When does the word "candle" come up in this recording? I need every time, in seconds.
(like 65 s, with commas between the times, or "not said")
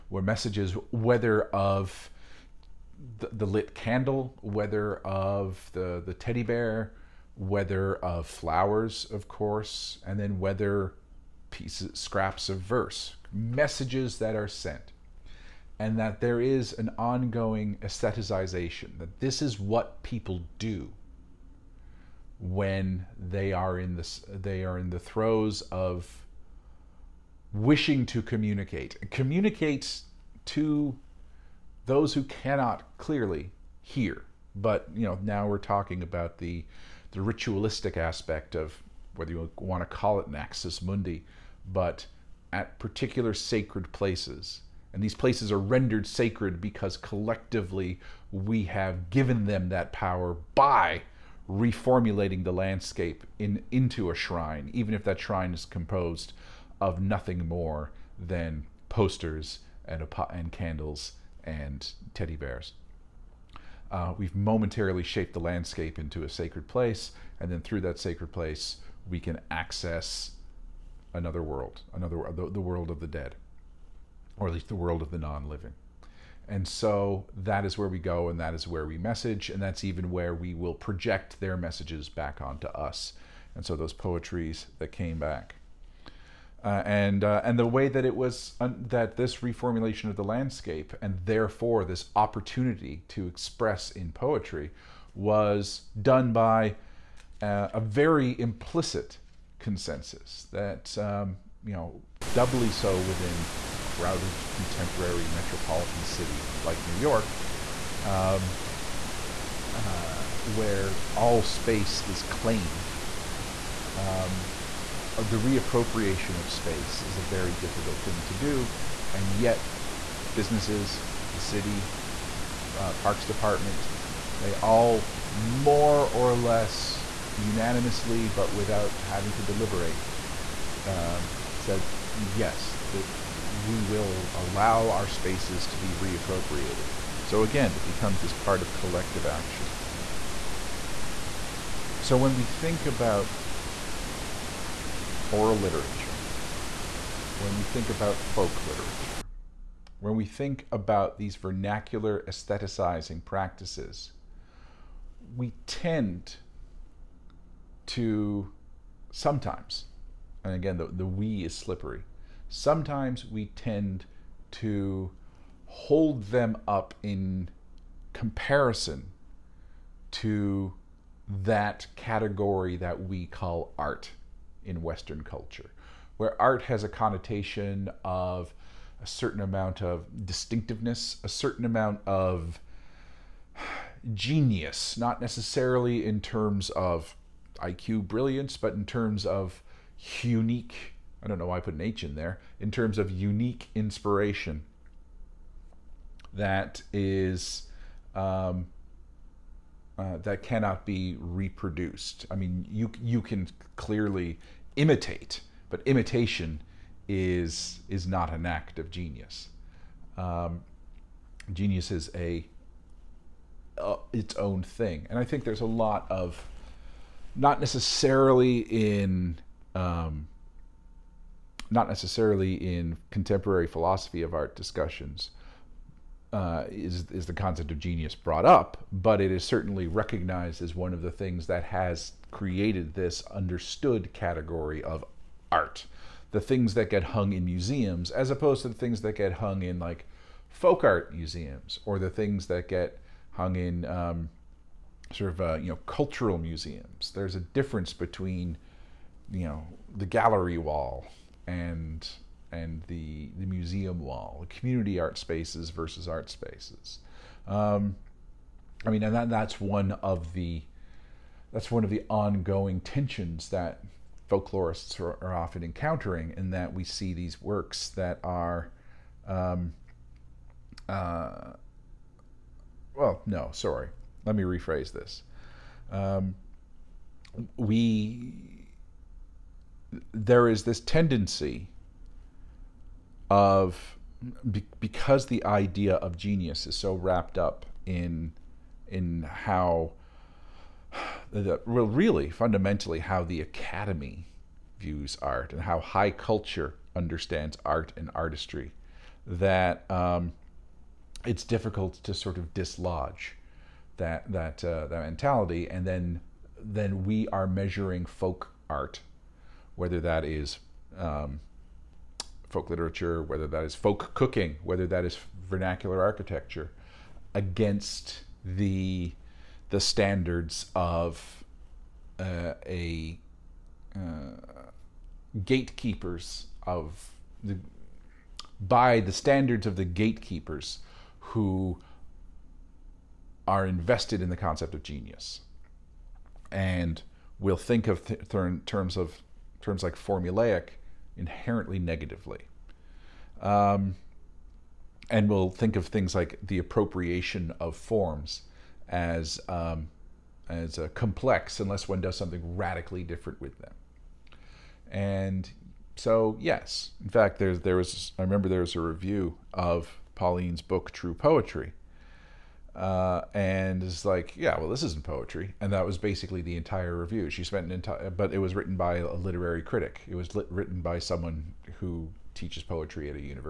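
3 s, 60 s.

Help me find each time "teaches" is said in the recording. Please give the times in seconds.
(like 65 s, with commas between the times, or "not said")
372 s.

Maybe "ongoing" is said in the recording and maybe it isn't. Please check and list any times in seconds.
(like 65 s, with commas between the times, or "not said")
16 s, 262 s.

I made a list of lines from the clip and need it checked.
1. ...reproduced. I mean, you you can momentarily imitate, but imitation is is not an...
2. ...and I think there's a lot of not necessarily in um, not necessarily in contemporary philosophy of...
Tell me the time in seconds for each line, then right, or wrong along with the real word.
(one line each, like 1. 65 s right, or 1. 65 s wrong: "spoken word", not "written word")
1. 201 s wrong: "clearly", not "momentarily"
2. 215 s right.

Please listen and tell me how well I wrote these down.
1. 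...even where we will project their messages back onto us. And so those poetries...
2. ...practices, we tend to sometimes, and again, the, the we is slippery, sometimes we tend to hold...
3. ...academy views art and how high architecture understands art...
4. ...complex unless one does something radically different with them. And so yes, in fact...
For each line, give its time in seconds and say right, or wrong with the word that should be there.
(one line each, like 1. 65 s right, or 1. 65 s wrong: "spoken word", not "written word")
1. 79 s right
2. 153 s right
3. 293 s wrong: "culture", not "architecture"
4. 350 s right.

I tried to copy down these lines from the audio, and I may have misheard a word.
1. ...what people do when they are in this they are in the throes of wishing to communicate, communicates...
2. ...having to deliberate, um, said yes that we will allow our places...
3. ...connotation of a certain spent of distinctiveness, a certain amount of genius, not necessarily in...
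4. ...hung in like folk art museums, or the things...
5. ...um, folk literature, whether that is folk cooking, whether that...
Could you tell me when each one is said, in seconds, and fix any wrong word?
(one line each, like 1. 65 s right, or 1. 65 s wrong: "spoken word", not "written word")
1. 19 s right
2. 129 s wrong: "spaces", not "places"
3. 176 s wrong: "amount", not "spent"
4. 239 s right
5. 310 s right.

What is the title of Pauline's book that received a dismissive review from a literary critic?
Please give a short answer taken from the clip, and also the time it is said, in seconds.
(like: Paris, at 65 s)
True Poetry, at 360 s.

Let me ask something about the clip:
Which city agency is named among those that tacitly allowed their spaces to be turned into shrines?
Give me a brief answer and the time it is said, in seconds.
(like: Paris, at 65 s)
Parks department, at 122 s.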